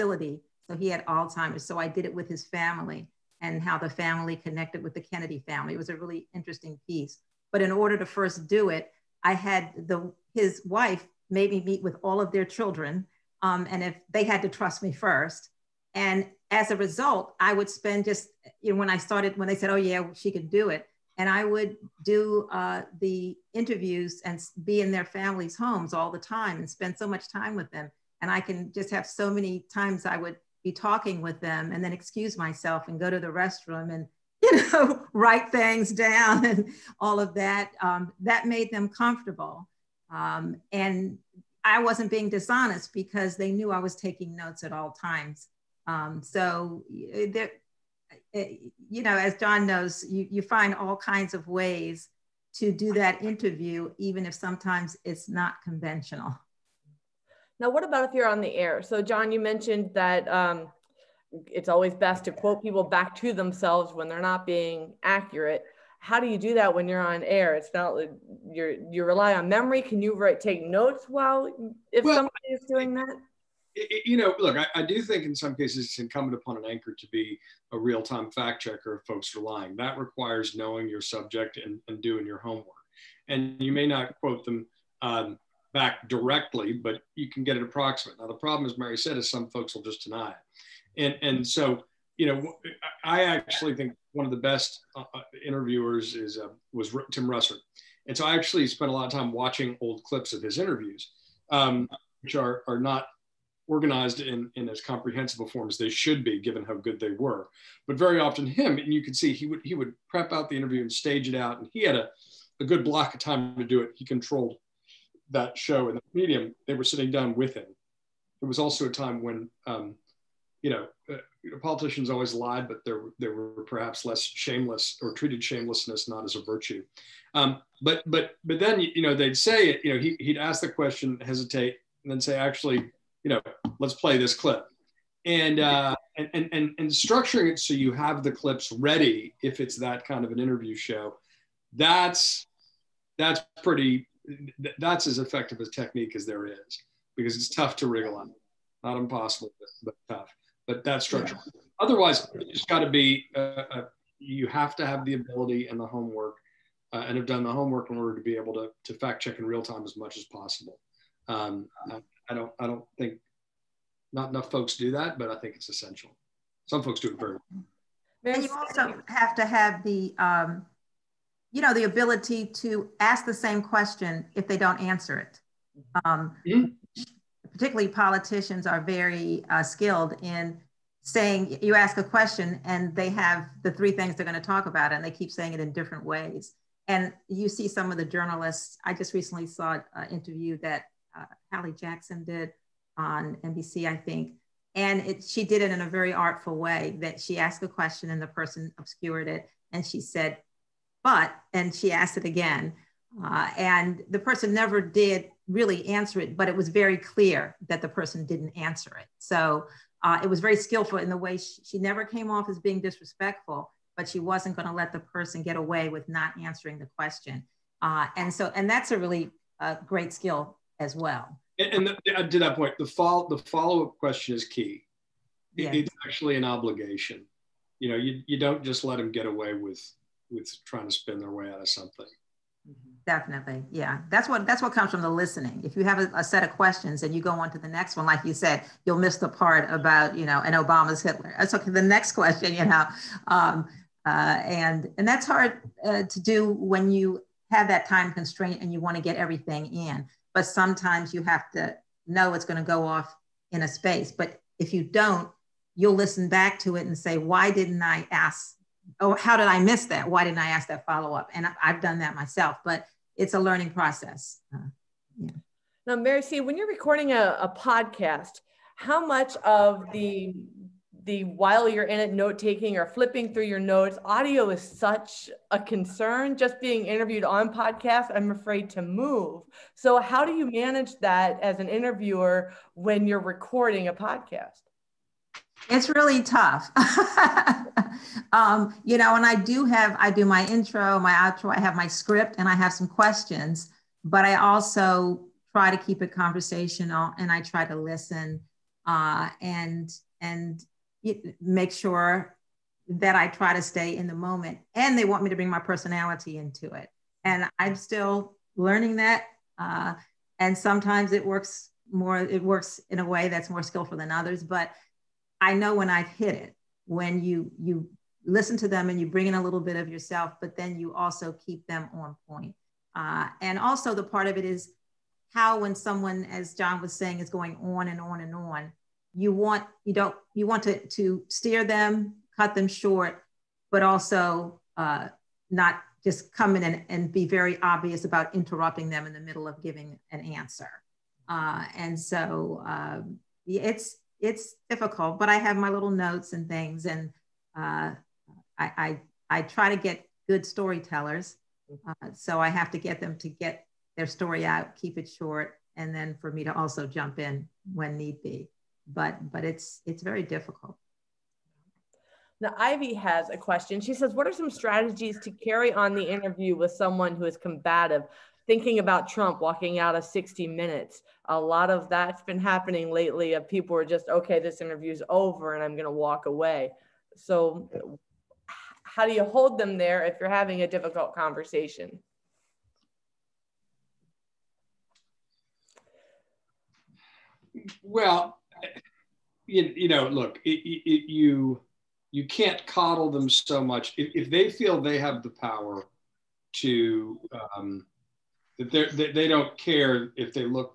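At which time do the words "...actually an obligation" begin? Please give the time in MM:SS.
03:46.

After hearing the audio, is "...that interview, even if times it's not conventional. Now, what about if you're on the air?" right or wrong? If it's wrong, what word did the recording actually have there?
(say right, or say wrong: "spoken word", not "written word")
wrong: "sometimes", not "times".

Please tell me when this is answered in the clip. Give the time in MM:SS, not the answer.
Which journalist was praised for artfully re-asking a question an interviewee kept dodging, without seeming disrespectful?
03:11.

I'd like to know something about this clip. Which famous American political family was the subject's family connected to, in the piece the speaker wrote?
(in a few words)
Kennedy family.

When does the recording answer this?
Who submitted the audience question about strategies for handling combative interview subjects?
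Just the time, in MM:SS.
06:02.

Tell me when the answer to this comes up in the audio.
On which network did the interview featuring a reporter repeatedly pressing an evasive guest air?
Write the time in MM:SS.
03:13.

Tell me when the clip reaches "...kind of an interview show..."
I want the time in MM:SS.
02:20.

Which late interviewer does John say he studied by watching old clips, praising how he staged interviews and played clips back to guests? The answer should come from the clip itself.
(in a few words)
Tim Russert.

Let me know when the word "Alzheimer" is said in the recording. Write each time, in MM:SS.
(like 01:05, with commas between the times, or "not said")
00:01.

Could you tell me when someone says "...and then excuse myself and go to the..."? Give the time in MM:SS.
00:31.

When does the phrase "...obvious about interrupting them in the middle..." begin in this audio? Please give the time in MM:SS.
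05:37.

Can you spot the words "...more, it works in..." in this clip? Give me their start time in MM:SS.
05:11.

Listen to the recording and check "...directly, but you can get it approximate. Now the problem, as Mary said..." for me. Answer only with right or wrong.
right.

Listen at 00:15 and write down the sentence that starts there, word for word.
And as a result, I would spend just, you know, when I started, when they said, oh, yeah, she could do it.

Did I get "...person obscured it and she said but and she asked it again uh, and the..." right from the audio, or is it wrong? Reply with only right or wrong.
right.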